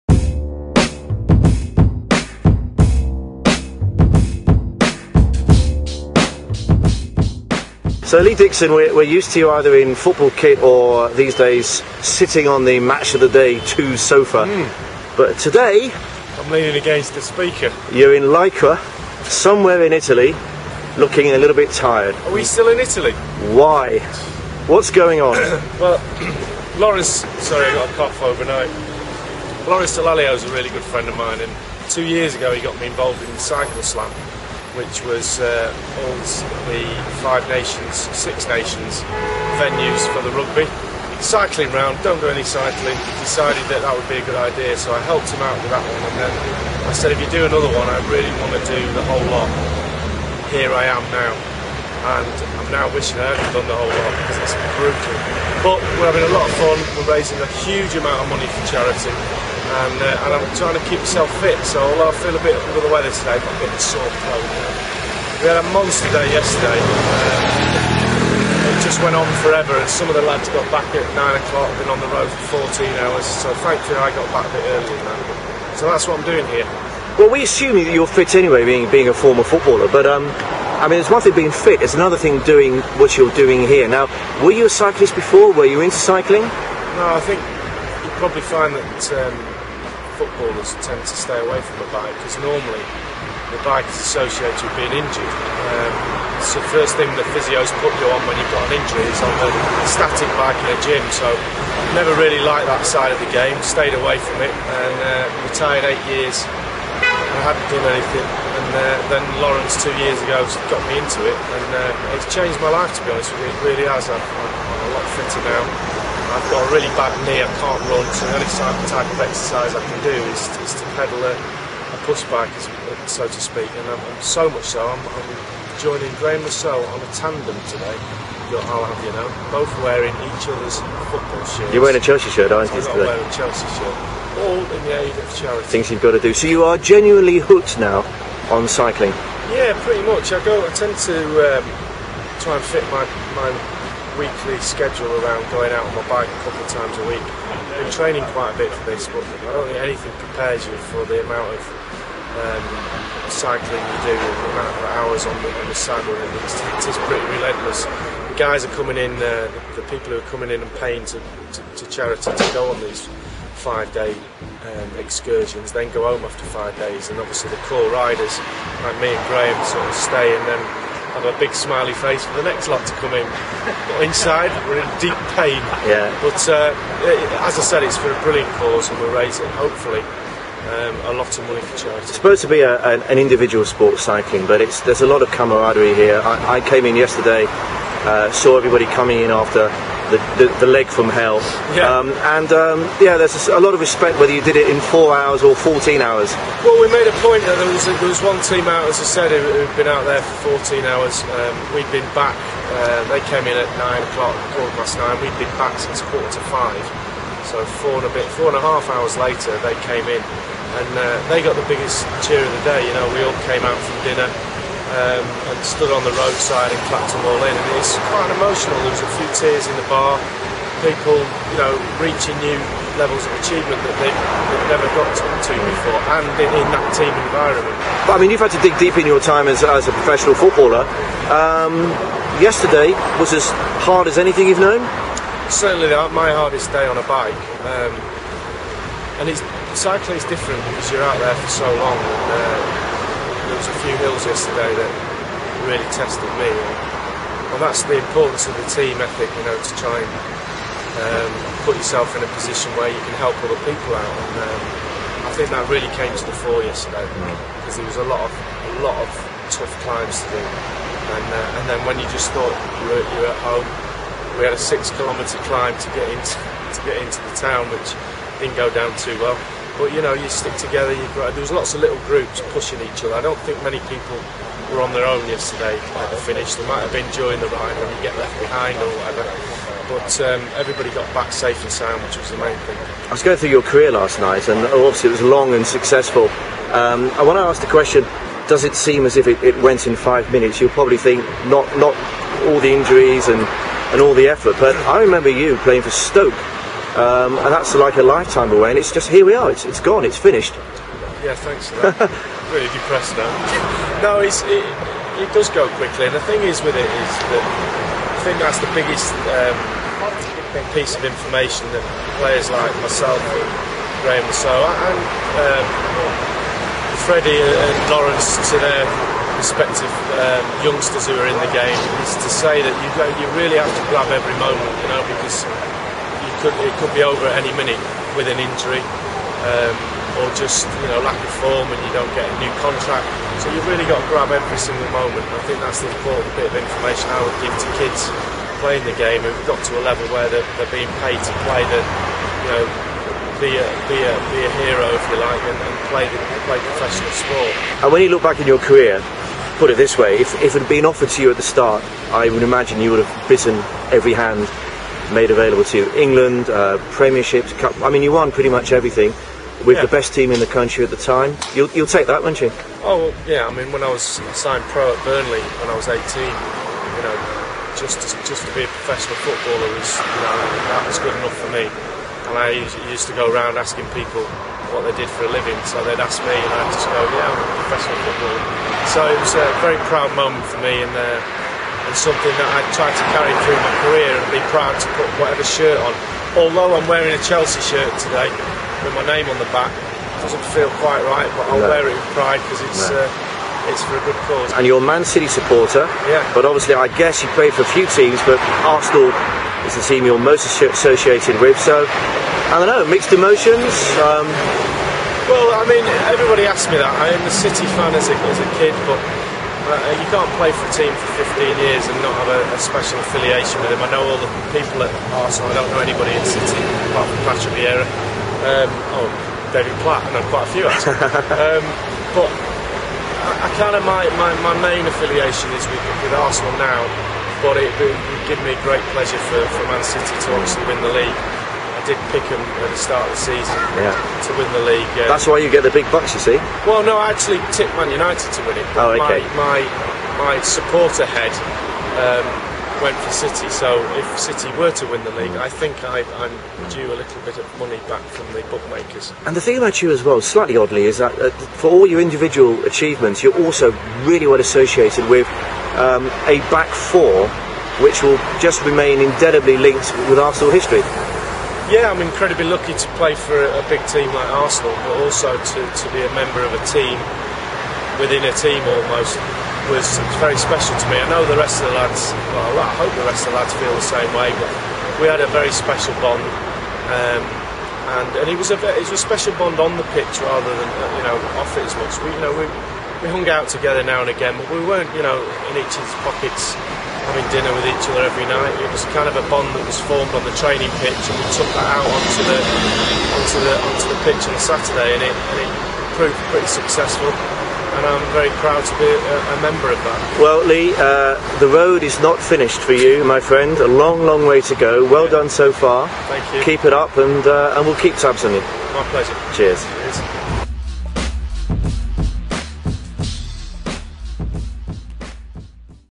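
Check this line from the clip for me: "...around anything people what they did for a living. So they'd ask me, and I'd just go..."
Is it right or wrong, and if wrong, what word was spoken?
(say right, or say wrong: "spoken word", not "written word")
wrong: "asking", not "anything".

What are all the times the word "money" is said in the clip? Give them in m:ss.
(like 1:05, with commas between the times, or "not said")
0:58, 3:01, 7:27.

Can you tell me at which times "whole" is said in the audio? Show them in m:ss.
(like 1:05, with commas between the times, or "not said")
0:49, 0:53.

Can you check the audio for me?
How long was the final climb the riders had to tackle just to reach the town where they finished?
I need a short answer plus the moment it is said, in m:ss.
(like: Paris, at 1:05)
6 kilometres, at 4:24.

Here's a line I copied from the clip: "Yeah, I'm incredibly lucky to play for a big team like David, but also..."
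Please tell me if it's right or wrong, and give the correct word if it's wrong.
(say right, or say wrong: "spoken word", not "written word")
wrong: "Arsenal", not "David".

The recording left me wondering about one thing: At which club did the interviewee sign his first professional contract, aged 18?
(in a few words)
Burnley.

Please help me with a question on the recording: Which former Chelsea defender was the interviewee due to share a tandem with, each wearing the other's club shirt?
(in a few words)
Graeme Le Saux.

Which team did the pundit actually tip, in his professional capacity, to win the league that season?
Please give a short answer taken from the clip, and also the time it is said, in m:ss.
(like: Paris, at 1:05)
Man United, at 7:17.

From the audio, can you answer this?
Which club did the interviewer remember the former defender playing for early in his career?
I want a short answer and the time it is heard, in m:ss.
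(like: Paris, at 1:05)
Stoke, at 4:55.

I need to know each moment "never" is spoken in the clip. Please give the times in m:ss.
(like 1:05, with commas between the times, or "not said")
1:41, 3:44.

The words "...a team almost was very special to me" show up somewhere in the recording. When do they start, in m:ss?
7:48.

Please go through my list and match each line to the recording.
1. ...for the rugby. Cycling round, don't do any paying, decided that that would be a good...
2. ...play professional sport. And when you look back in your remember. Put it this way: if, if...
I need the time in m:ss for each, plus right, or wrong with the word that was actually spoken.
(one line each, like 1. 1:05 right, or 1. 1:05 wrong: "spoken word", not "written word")
1. 0:40 wrong: "cycling", not "paying"
2. 5:46 wrong: "career", not "remember".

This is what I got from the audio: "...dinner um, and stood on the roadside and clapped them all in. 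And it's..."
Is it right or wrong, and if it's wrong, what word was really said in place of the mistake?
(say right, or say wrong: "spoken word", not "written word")
right.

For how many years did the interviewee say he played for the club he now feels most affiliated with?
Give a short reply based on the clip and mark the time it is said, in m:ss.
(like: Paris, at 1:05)
15, at 6:51.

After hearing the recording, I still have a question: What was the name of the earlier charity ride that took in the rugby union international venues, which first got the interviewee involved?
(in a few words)
Cycle Slam.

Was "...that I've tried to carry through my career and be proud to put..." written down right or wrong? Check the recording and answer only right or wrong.
right.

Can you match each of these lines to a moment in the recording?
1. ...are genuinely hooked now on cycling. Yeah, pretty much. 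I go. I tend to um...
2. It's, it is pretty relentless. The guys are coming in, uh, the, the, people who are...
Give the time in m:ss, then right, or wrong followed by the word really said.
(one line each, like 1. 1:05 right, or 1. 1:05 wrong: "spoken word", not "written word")
1. 2:16 right
2. 2:36 right.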